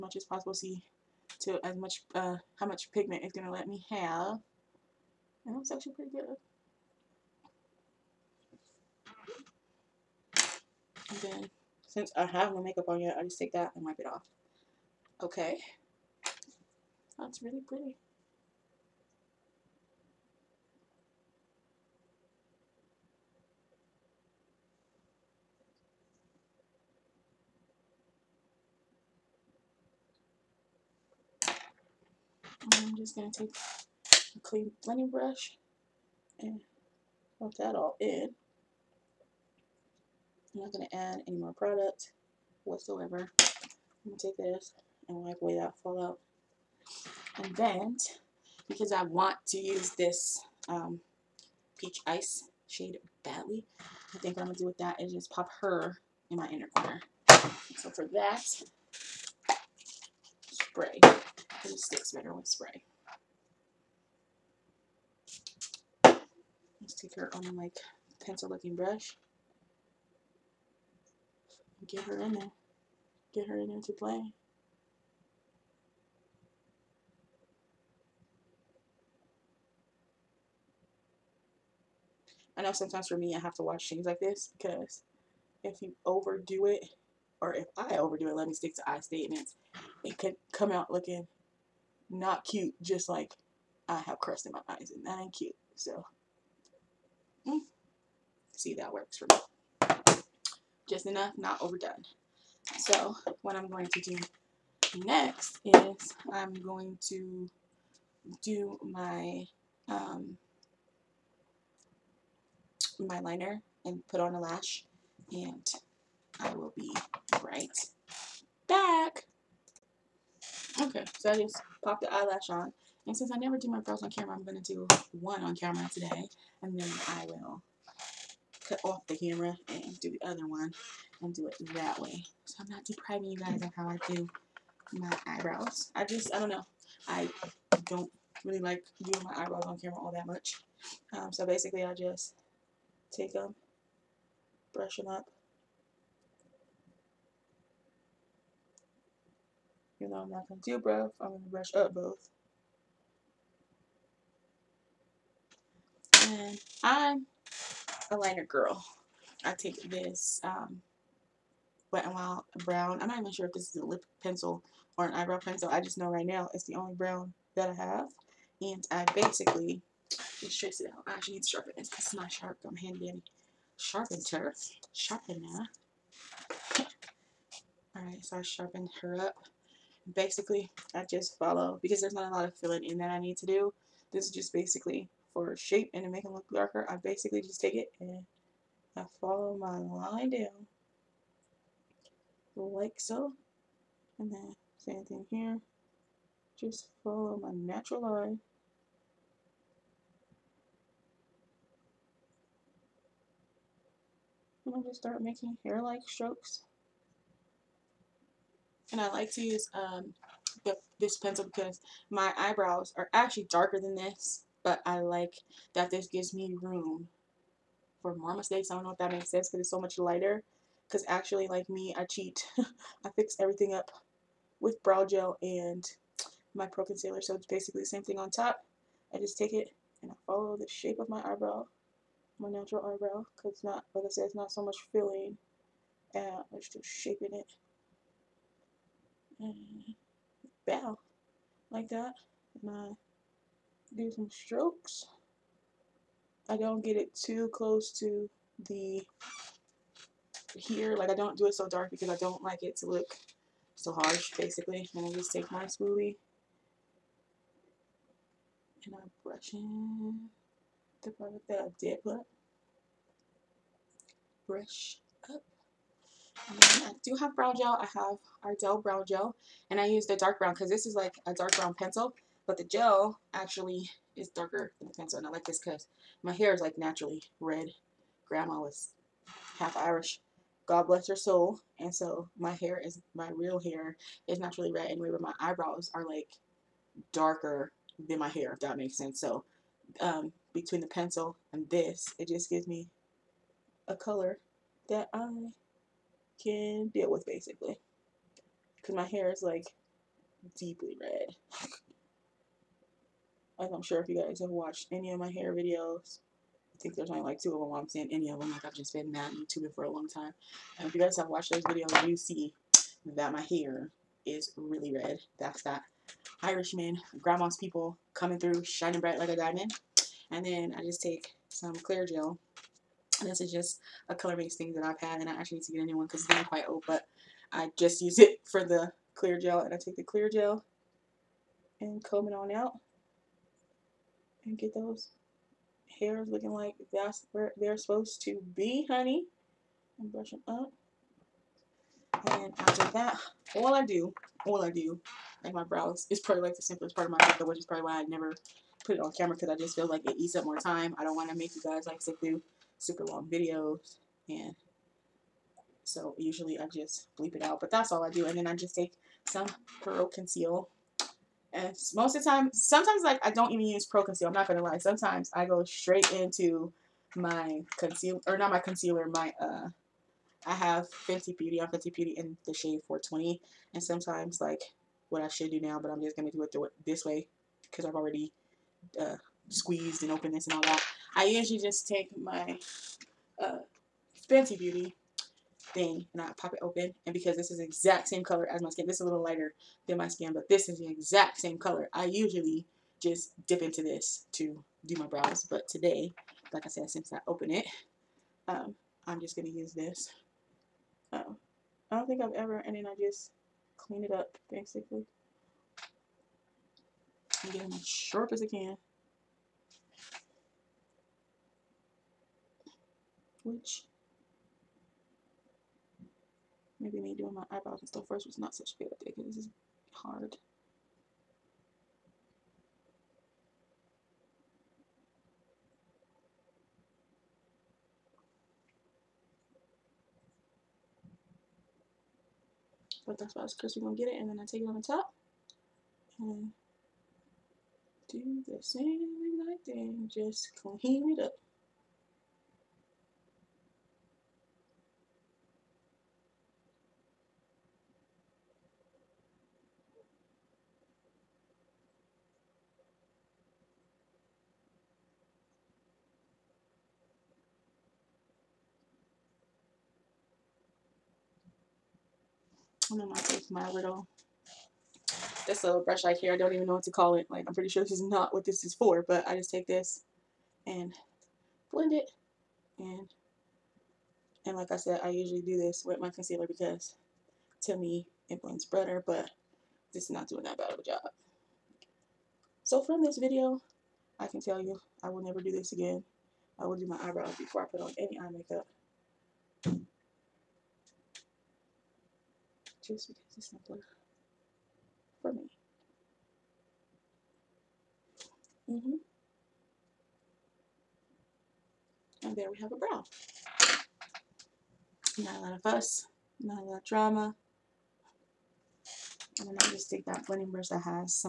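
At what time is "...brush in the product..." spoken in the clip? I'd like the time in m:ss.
4:19.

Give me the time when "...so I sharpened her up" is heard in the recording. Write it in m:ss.
2:58.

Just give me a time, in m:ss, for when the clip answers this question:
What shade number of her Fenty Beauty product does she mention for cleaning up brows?
6:12.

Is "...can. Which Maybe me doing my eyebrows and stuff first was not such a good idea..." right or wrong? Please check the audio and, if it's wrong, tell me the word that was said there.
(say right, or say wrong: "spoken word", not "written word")
right.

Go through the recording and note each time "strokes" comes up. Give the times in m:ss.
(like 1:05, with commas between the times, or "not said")
3:26, 4:04.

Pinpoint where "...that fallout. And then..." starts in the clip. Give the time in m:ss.
0:45.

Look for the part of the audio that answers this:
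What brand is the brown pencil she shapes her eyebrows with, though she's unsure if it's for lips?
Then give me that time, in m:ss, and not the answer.
2:41.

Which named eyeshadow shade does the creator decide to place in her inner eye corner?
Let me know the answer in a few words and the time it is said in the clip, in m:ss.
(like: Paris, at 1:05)
Peach Ice, at 0:51.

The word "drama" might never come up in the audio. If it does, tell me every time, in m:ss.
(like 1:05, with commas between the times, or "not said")
8:26.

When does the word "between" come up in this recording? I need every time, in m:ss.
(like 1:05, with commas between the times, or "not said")
4:50.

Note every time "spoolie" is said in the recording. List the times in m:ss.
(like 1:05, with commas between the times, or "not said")
4:15.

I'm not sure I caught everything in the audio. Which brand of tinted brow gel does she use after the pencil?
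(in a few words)
Ardell.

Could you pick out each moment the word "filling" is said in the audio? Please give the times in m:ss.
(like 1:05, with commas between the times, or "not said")
3:02, 3:54.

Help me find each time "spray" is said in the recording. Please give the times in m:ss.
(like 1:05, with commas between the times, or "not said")
0:58, 1:02.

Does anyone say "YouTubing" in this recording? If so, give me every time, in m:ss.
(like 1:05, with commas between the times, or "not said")
5:09.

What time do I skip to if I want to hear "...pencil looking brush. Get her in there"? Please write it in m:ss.
1:08.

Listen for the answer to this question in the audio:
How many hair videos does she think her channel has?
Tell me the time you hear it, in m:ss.
5:07.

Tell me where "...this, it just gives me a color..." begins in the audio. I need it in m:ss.
4:51.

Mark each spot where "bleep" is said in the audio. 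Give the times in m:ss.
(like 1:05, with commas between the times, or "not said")
5:57.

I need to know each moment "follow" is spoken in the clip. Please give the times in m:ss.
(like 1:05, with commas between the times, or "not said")
3:01, 3:09, 3:17, 3:50.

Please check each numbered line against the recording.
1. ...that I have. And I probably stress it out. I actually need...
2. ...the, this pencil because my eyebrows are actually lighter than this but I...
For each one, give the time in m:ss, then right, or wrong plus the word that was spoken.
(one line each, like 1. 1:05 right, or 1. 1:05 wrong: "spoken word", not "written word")
1. 2:47 wrong: "basically", not "probably"
2. 3:30 wrong: "darker", not "lighter".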